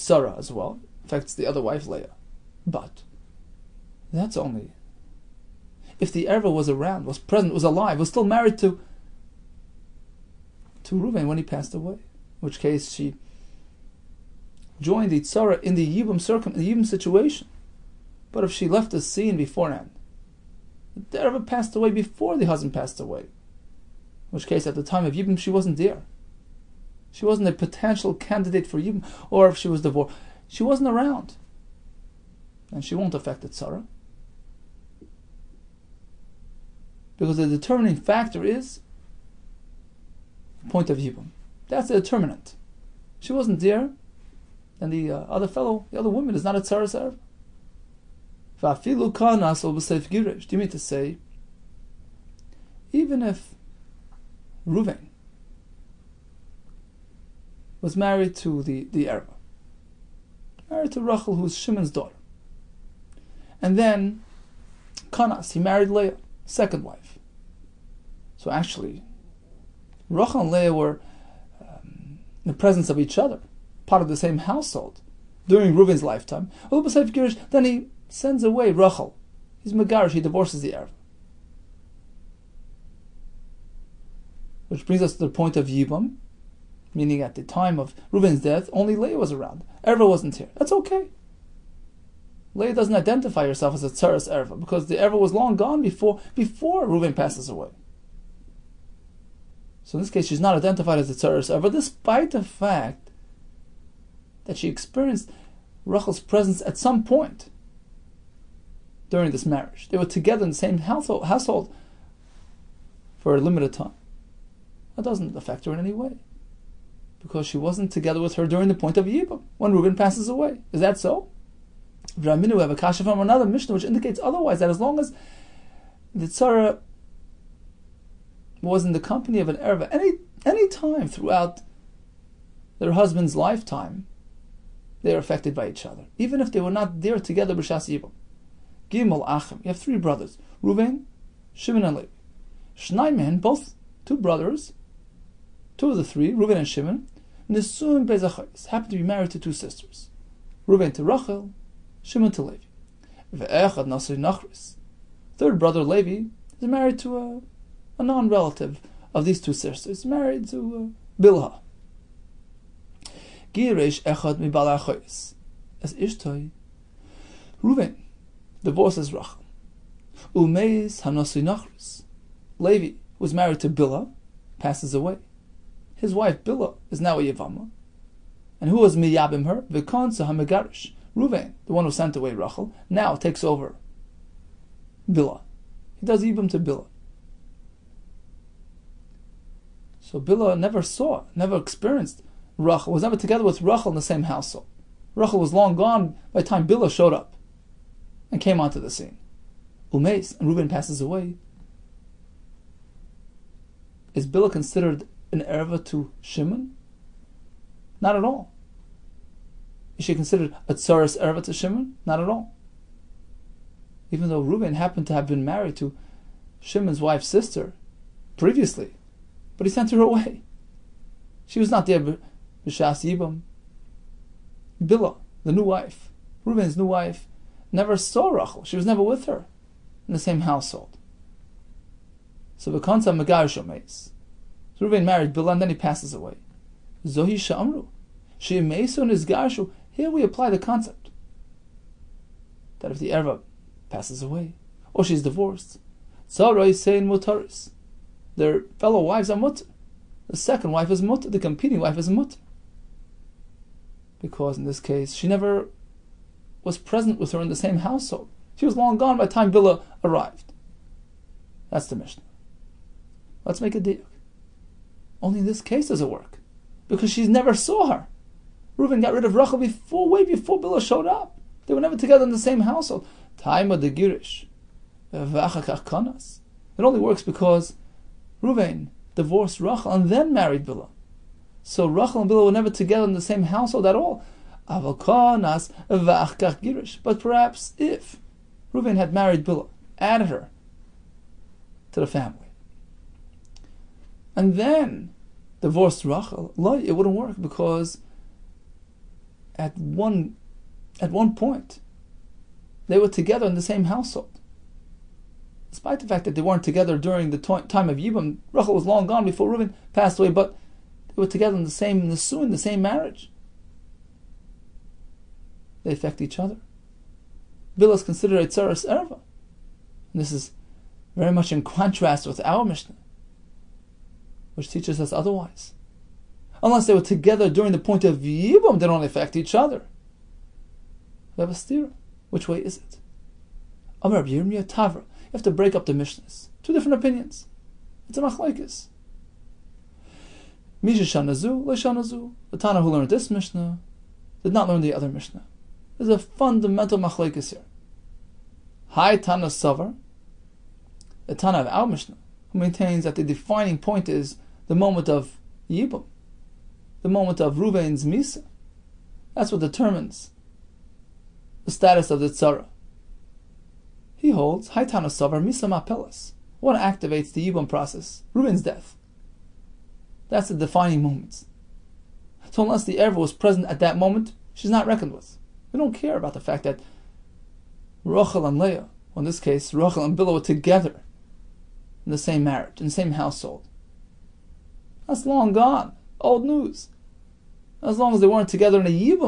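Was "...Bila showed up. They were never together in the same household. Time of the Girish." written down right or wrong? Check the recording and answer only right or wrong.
right.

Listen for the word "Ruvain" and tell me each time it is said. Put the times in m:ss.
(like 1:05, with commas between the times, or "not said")
4:38, 5:57.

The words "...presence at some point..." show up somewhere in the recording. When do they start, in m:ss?
1:46.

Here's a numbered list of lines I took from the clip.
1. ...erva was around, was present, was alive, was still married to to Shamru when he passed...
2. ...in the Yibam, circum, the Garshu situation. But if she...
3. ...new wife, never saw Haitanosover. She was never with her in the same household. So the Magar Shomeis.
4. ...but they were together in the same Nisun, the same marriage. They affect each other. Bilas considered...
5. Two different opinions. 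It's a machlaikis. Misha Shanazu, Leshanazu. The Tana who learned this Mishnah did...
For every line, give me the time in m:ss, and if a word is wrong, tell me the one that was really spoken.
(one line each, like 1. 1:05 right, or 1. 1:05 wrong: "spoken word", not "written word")
1. 0:06 wrong: "Reuven", not "Shamru"
2. 0:15 wrong: "Yibam", not "Garshu"
3. 3:46 wrong: "Rachel", not "Haitanosover"
4. 5:10 right
5. 5:36 right.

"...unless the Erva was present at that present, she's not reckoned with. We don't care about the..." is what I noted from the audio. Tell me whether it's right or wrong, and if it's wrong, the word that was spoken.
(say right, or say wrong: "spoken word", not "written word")
wrong: "moment", not "present".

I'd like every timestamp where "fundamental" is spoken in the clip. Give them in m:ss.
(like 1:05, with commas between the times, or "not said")
5:46.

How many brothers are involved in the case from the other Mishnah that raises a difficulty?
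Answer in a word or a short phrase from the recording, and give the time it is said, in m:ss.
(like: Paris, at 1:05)
3, at 2:19.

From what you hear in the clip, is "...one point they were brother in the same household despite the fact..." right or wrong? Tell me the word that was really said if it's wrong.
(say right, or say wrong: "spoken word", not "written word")
wrong: "together", not "brother".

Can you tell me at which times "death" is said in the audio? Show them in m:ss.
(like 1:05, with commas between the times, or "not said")
1:28, 6:08.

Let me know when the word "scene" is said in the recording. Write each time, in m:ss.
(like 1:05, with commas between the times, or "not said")
0:19, 3:18.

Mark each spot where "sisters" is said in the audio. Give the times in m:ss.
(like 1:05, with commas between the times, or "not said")
2:29, 2:39, 3:37.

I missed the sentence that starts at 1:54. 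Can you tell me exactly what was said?
That doesn't affect her in any way because she wasn't together with her during the point of Yibam, when Reuben passes away.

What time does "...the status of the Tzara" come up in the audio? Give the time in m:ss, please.
6:01.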